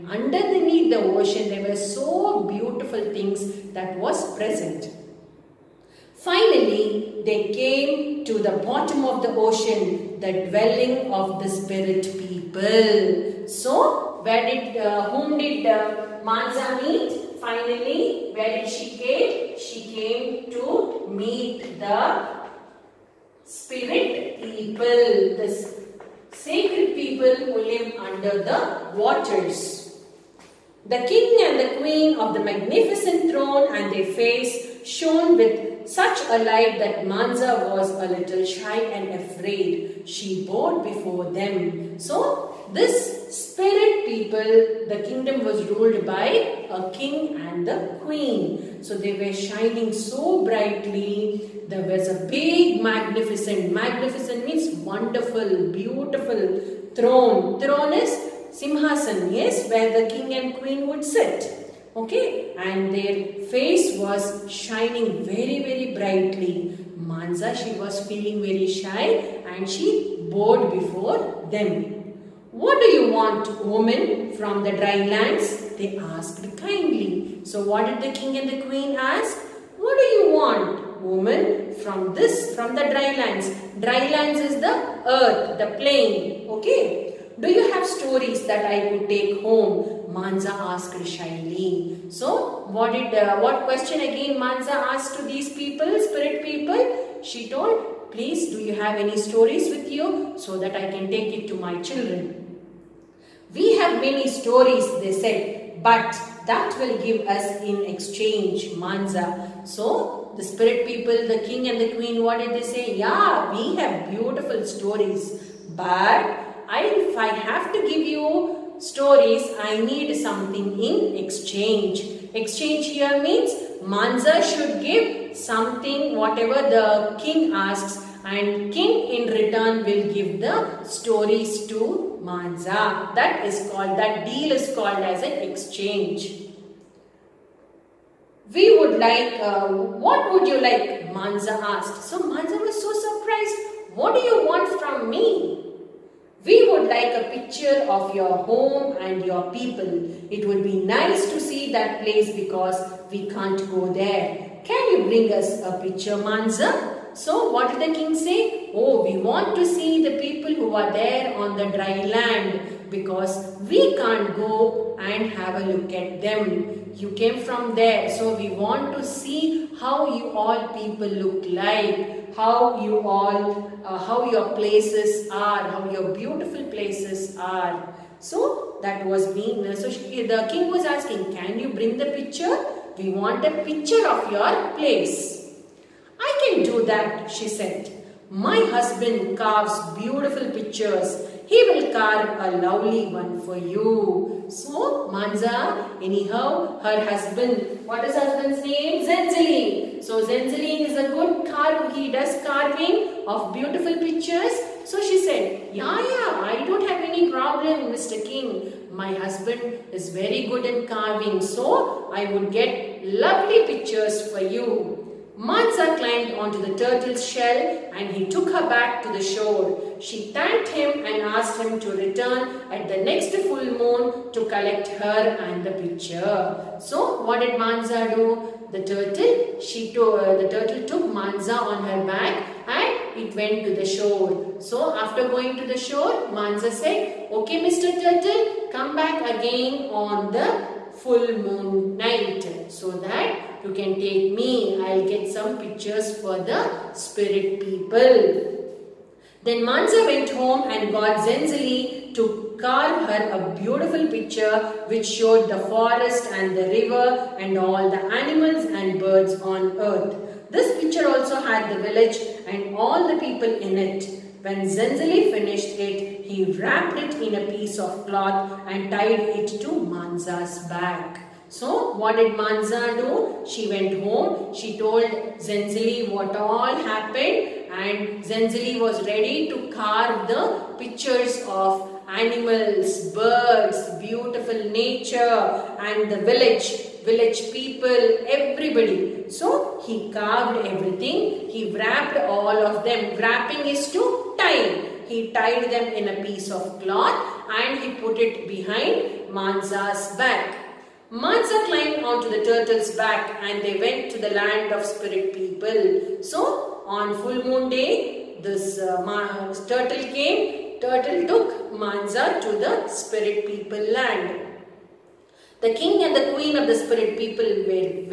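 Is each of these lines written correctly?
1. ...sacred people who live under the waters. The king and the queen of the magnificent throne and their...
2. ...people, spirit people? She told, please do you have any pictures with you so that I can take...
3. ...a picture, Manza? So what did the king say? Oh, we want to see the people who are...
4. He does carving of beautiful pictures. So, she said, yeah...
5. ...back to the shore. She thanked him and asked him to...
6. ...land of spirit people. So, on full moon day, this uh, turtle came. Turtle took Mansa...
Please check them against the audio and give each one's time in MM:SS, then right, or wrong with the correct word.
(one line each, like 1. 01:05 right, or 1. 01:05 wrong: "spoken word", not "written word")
1. 00:26 right
2. 01:35 wrong: "stories", not "pictures"
3. 02:35 right
4. 03:21 right
5. 03:38 right
6. 05:04 right.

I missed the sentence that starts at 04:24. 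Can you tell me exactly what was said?
When Zenzili finished it, he wrapped it in a piece of cloth and tied it to Manza's back.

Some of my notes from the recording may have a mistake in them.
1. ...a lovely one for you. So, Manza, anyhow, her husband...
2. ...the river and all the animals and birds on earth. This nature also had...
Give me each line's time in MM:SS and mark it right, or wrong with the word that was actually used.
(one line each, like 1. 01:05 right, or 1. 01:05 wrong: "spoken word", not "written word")
1. 03:12 right
2. 04:16 wrong: "picture", not "nature".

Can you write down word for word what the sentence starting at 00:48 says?
So they were shining so brightly.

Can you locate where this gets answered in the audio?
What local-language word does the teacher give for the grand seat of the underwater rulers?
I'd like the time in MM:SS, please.
00:58.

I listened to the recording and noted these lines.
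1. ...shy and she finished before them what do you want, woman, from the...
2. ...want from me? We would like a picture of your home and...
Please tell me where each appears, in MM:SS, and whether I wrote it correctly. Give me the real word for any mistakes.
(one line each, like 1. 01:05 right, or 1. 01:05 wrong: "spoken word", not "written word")
1. 01:08 wrong: "bowed", not "finished"
2. 02:24 right.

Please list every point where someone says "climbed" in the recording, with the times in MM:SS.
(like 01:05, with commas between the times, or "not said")
03:35, 05:01.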